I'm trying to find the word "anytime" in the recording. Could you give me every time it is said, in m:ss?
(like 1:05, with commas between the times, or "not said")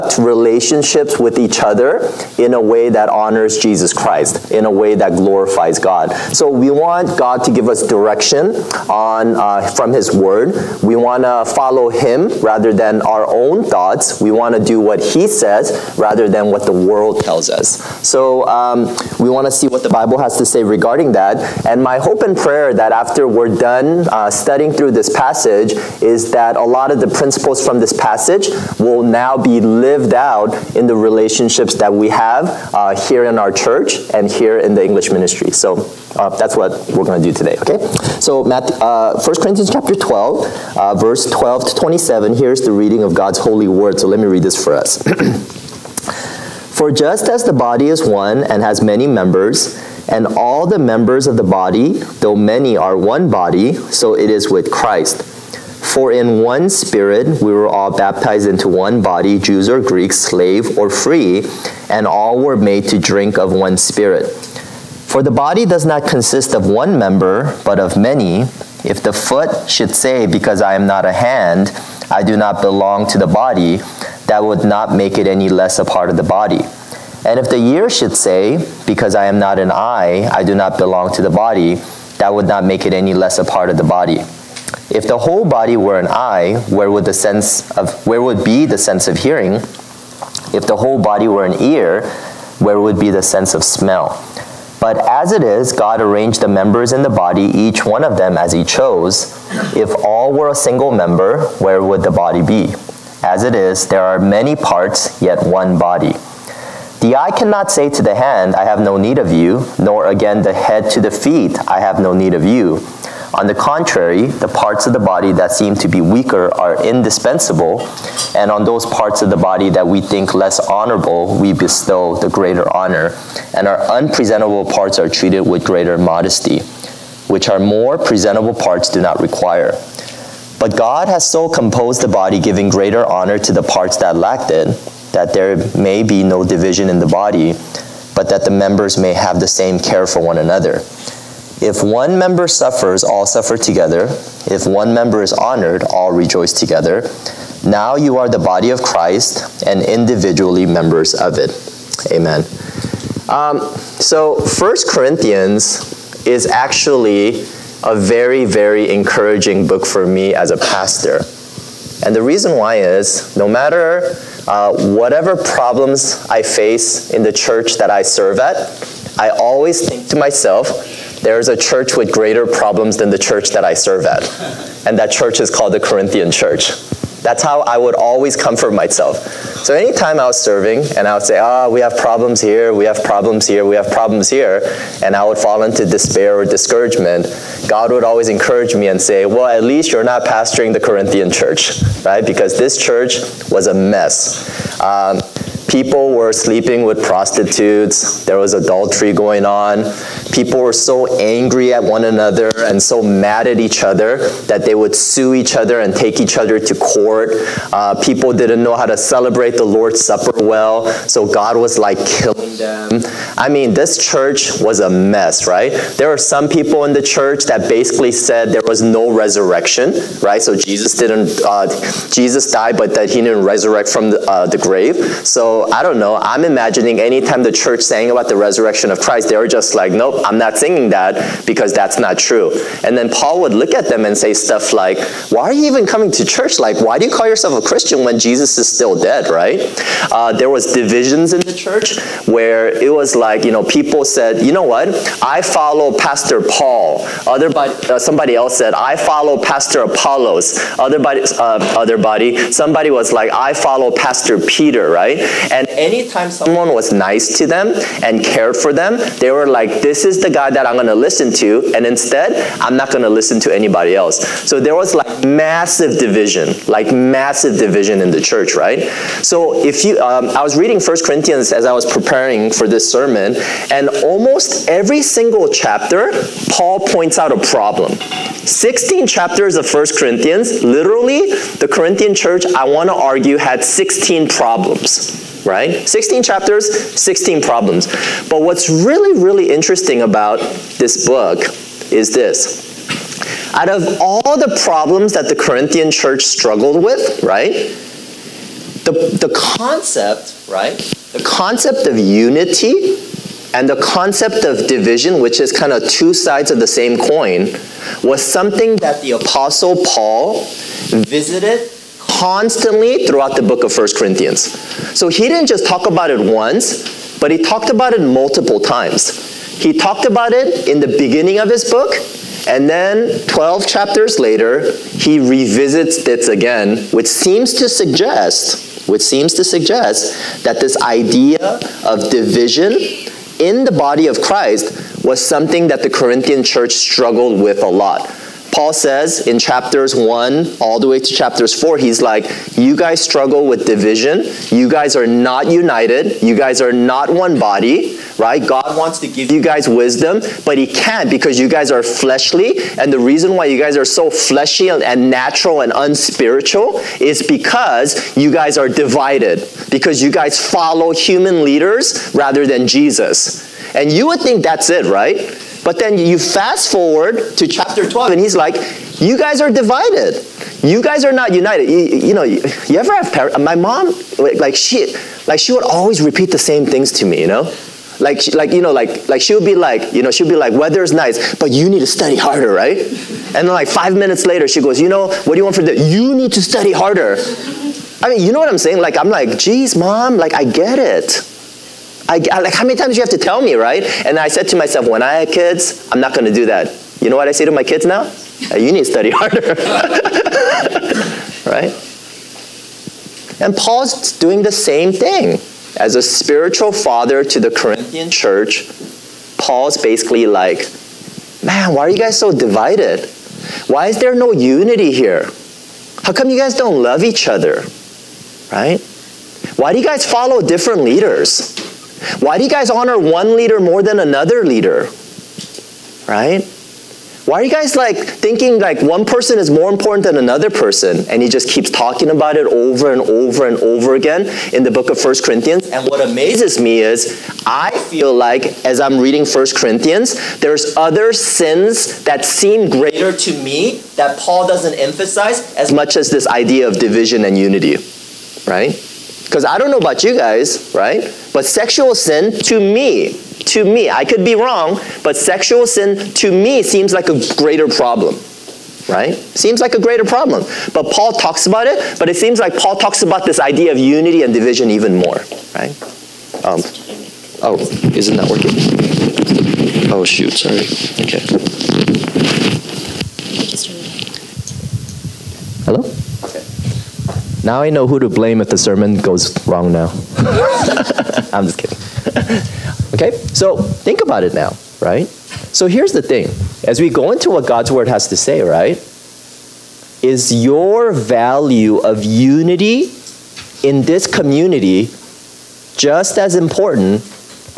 2:59, 3:46, 4:15.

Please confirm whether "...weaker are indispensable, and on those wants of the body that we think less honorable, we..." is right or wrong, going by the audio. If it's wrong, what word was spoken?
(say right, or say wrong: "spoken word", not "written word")
wrong: "parts", not "wants".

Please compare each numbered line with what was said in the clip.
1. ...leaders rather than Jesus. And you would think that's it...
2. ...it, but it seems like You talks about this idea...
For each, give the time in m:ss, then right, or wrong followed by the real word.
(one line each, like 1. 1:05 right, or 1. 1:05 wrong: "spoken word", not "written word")
1. 6:01 right
2. 7:41 wrong: "Paul", not "You".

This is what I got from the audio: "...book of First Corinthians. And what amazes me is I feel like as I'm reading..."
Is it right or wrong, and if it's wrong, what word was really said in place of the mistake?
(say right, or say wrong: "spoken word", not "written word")
right.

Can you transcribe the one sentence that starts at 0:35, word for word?
So uh, that's what we're going to do today, okay?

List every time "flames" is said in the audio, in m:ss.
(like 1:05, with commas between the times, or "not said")
not said.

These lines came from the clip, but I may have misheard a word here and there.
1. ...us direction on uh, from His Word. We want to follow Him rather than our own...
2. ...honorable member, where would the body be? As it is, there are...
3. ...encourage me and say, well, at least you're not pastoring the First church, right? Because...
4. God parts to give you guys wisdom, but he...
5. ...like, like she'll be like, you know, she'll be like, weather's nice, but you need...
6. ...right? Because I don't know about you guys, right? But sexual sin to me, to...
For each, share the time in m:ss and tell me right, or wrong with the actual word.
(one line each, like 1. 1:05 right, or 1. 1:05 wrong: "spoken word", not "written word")
1. 0:07 right
2. 1:40 wrong: "single", not "honorable"
3. 3:08 wrong: "Corinthian", not "First"
4. 5:48 wrong: "wants", not "parts"
5. 6:18 right
6. 7:28 right.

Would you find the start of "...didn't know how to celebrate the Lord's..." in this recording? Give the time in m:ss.
3:28.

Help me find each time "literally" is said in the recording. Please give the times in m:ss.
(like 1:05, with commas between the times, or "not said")
4:40.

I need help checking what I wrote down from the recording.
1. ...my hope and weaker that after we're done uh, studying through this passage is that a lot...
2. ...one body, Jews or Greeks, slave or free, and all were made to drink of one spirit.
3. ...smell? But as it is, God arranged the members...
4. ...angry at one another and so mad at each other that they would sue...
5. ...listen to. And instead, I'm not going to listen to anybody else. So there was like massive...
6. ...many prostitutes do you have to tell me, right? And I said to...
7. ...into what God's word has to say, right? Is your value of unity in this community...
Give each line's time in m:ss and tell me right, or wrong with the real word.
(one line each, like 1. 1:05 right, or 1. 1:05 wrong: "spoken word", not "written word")
1. 0:21 wrong: "prayer", not "weaker"
2. 0:58 right
3. 1:33 right
4. 3:21 right
5. 4:20 right
6. 6:32 wrong: "times", not "prostitutes"
7. 8:07 right.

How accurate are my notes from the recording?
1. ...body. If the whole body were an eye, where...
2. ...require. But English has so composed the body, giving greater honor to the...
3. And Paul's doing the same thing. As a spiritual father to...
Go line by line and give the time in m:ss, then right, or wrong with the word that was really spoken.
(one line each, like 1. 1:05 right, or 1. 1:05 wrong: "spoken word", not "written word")
1. 1:23 right
2. 2:09 wrong: "God", not "English"
3. 6:43 right.